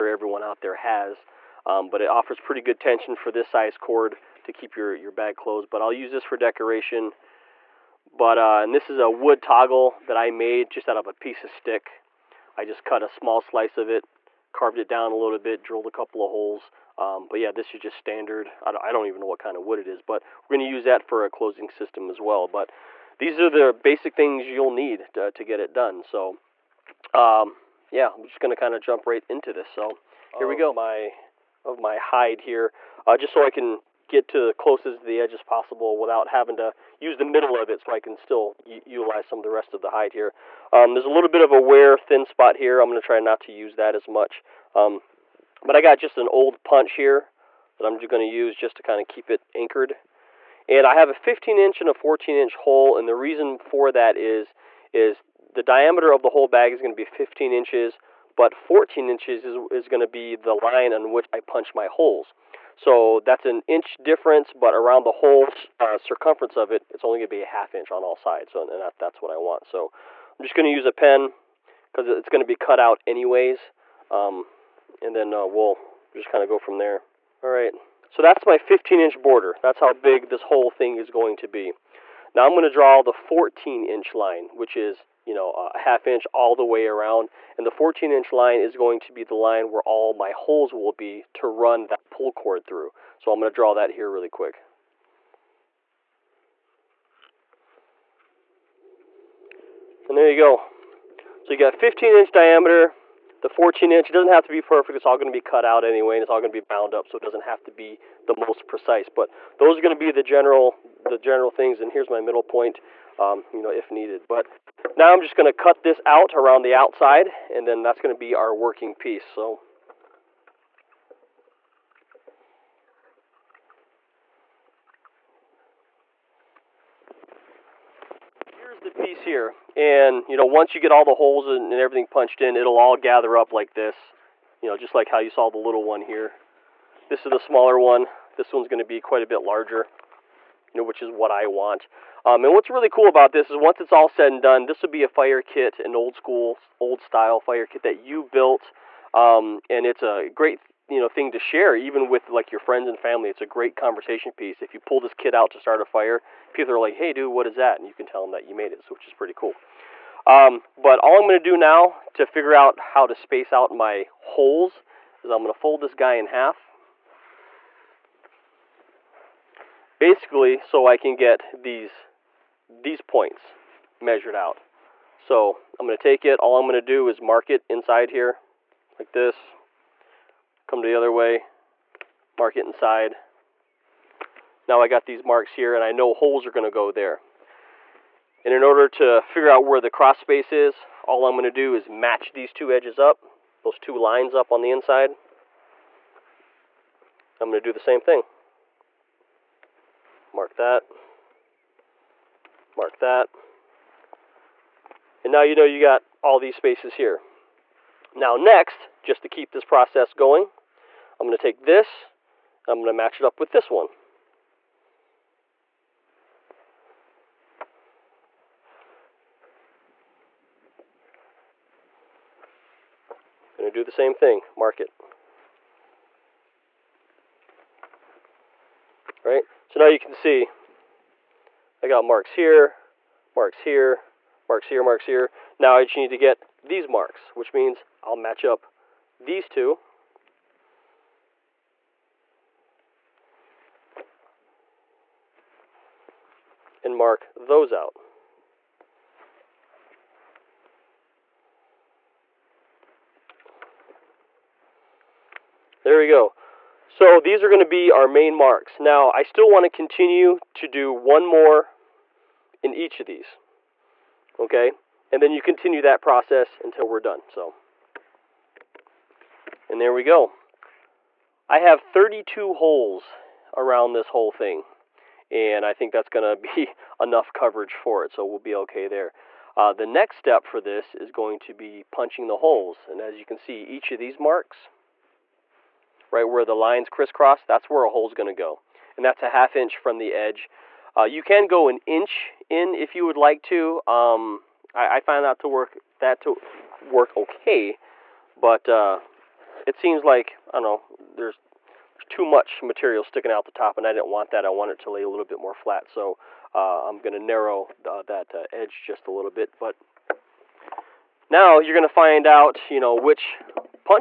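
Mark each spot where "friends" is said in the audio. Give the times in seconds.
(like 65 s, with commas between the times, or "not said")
152 s.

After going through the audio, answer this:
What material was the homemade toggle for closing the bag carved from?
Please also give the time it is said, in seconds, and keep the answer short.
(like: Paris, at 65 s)
a piece of stick, at 11 s.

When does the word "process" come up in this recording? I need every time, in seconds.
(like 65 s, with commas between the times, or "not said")
209 s, 265 s.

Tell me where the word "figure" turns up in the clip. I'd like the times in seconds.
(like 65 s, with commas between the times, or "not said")
162 s, 189 s.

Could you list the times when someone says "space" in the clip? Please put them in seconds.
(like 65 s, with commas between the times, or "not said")
163 s, 190 s, 206 s.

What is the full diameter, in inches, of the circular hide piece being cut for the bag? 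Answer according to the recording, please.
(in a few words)
15 inches.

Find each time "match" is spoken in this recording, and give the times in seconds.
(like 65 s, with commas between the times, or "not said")
191 s, 212 s, 238 s.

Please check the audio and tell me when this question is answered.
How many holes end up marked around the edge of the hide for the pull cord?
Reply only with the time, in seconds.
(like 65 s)
271 s.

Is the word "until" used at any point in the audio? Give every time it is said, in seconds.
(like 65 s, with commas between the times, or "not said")
266 s.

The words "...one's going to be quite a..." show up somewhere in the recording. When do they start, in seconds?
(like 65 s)
138 s.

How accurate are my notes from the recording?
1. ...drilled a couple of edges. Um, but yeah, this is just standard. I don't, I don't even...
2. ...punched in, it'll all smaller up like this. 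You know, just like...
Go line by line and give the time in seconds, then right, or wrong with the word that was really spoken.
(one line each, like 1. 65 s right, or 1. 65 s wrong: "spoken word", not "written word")
1. 15 s wrong: "holes", not "edges"
2. 132 s wrong: "gather", not "smaller".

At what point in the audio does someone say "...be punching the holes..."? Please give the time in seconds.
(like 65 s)
281 s.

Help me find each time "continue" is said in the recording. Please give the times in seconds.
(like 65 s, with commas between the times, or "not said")
259 s, 265 s.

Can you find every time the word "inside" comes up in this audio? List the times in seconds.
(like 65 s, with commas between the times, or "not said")
177 s, 182 s, 194 s.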